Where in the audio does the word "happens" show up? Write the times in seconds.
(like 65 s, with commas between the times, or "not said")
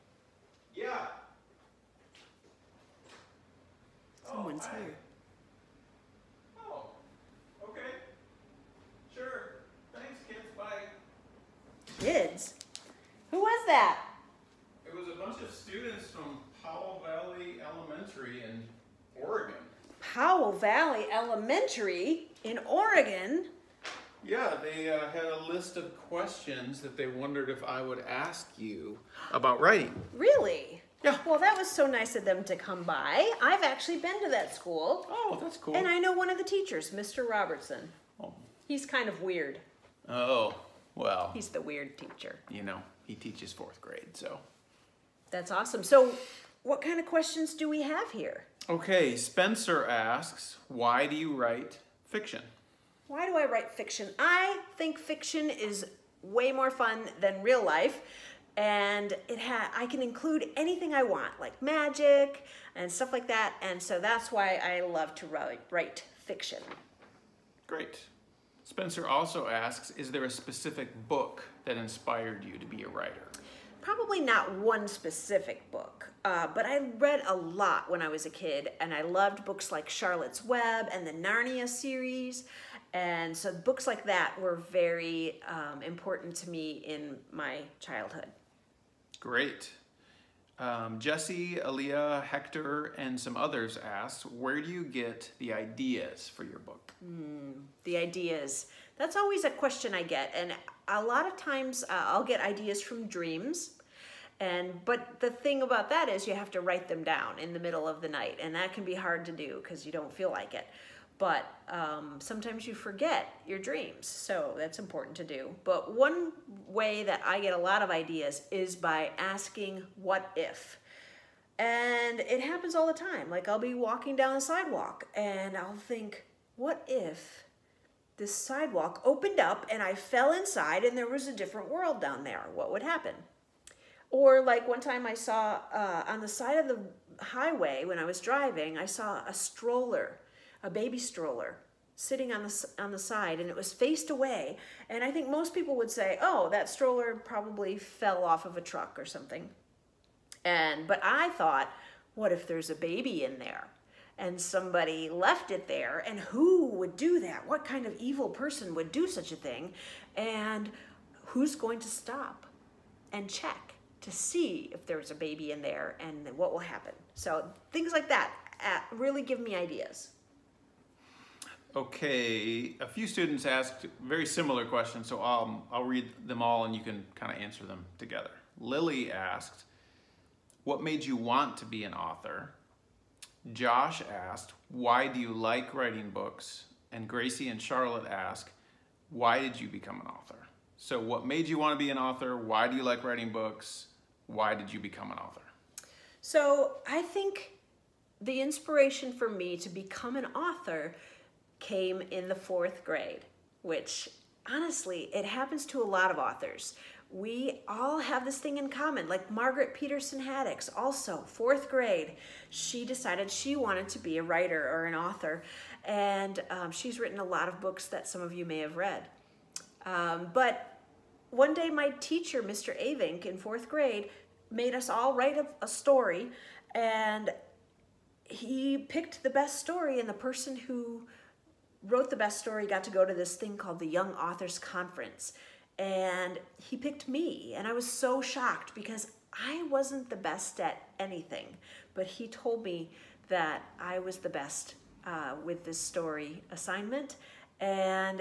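122 s, 132 s, 166 s, 205 s.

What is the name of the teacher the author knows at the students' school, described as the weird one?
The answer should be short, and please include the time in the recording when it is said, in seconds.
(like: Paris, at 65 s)
Mr. Robertson, at 36 s.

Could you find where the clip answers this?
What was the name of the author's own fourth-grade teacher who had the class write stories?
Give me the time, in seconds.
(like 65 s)
222 s.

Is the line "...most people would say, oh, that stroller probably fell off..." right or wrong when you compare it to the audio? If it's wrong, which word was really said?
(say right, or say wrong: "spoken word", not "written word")
right.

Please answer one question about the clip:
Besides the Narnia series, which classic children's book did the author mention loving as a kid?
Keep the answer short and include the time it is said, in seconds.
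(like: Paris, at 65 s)
Charlotte's Web, at 79 s.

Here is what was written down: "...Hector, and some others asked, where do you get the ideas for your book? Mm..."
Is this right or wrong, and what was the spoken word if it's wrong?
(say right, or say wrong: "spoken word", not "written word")
right.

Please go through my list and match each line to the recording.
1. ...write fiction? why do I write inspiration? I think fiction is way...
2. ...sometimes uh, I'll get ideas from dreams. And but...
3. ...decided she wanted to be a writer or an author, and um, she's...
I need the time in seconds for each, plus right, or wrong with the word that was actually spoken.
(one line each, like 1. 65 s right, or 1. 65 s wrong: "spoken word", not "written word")
1. 51 s wrong: "fiction", not "inspiration"
2. 101 s wrong: "times", not "sometimes"
3. 212 s right.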